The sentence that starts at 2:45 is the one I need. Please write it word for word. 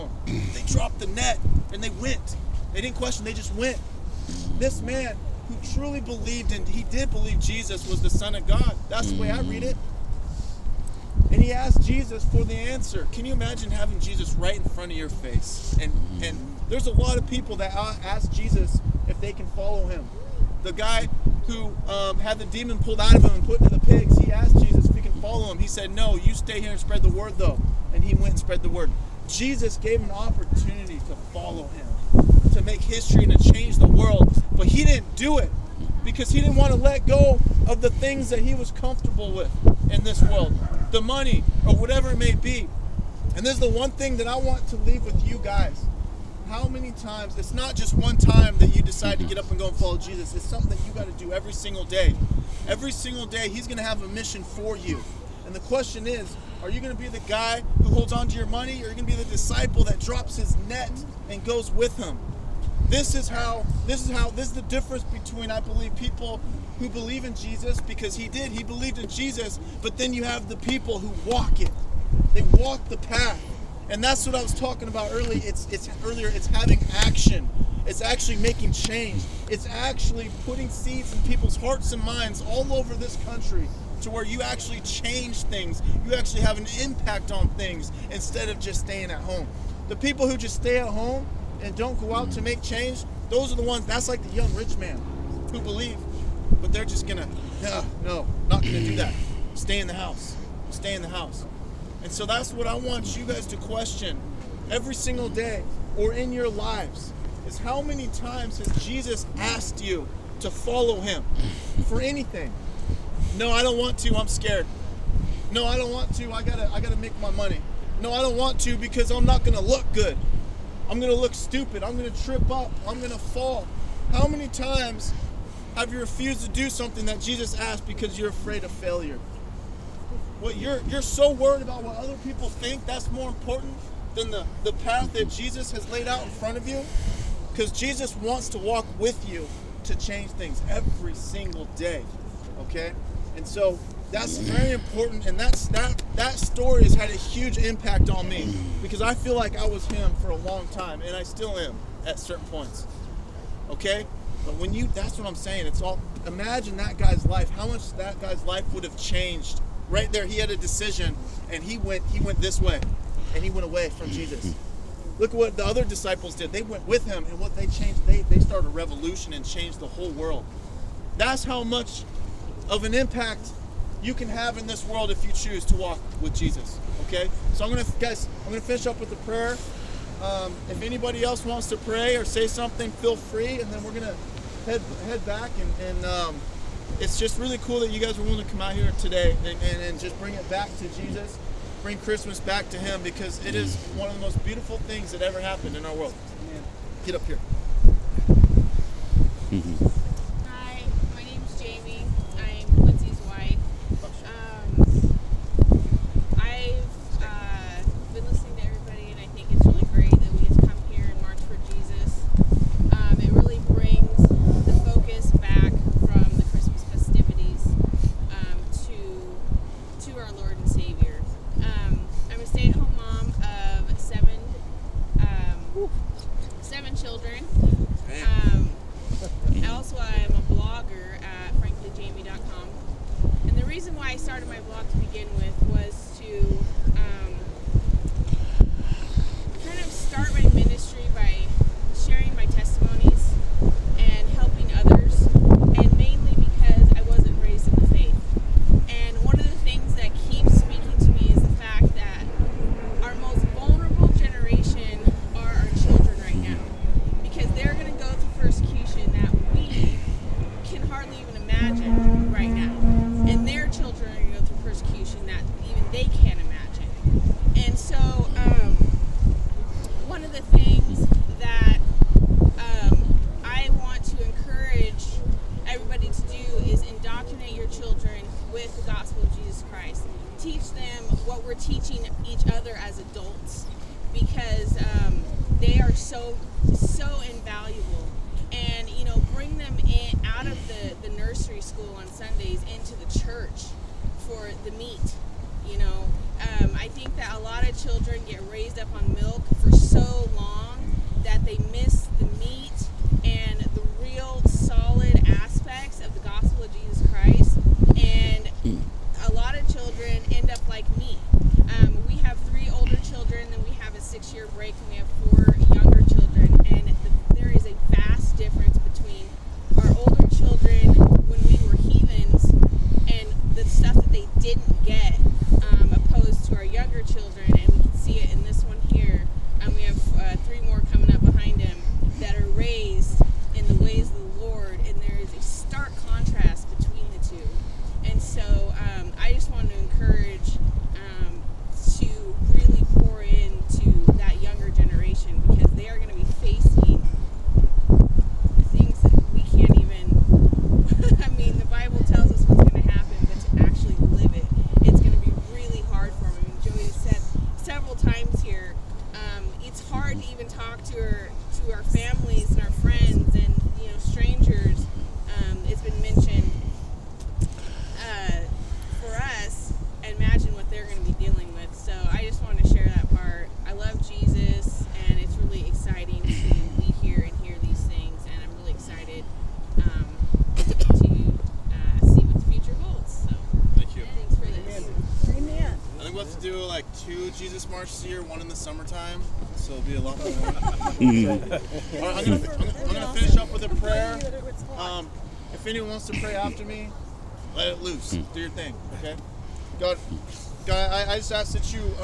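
Look what the other disciples did.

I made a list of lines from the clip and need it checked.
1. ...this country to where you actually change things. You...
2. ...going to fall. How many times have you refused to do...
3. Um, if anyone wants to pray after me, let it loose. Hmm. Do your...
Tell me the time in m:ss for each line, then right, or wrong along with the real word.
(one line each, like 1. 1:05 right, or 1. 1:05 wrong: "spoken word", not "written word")
1. 1:22 right
2. 2:02 right
3. 6:34 right.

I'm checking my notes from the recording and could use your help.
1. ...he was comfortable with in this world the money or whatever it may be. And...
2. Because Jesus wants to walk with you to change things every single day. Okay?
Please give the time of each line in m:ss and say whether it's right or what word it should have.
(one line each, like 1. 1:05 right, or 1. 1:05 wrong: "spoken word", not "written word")
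1. 0:38 right
2. 2:17 right.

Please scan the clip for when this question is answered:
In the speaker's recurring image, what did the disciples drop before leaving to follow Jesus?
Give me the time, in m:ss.
0:00.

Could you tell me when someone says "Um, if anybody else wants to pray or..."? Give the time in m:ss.
3:00.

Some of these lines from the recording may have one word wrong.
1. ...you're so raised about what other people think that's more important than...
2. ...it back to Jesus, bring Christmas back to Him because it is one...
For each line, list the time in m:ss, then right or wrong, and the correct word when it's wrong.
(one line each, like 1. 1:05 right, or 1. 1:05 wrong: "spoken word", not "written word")
1. 2:10 wrong: "worried", not "raised"
2. 3:10 right.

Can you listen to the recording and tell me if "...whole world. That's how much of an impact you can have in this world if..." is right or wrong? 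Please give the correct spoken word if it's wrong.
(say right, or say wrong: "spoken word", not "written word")
right.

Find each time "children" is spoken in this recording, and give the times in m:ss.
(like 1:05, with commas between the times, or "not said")
4:57.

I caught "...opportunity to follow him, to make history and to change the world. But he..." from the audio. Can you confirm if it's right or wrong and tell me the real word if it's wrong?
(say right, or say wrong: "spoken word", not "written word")
right.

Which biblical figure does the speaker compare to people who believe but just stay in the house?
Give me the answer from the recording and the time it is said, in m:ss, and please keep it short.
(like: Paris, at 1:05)
the young rich man, at 1:34.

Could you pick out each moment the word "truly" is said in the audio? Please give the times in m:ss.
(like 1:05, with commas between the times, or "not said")
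0:05.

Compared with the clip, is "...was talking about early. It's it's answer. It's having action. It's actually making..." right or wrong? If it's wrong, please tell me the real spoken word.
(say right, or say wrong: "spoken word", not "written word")
wrong: "earlier", not "answer".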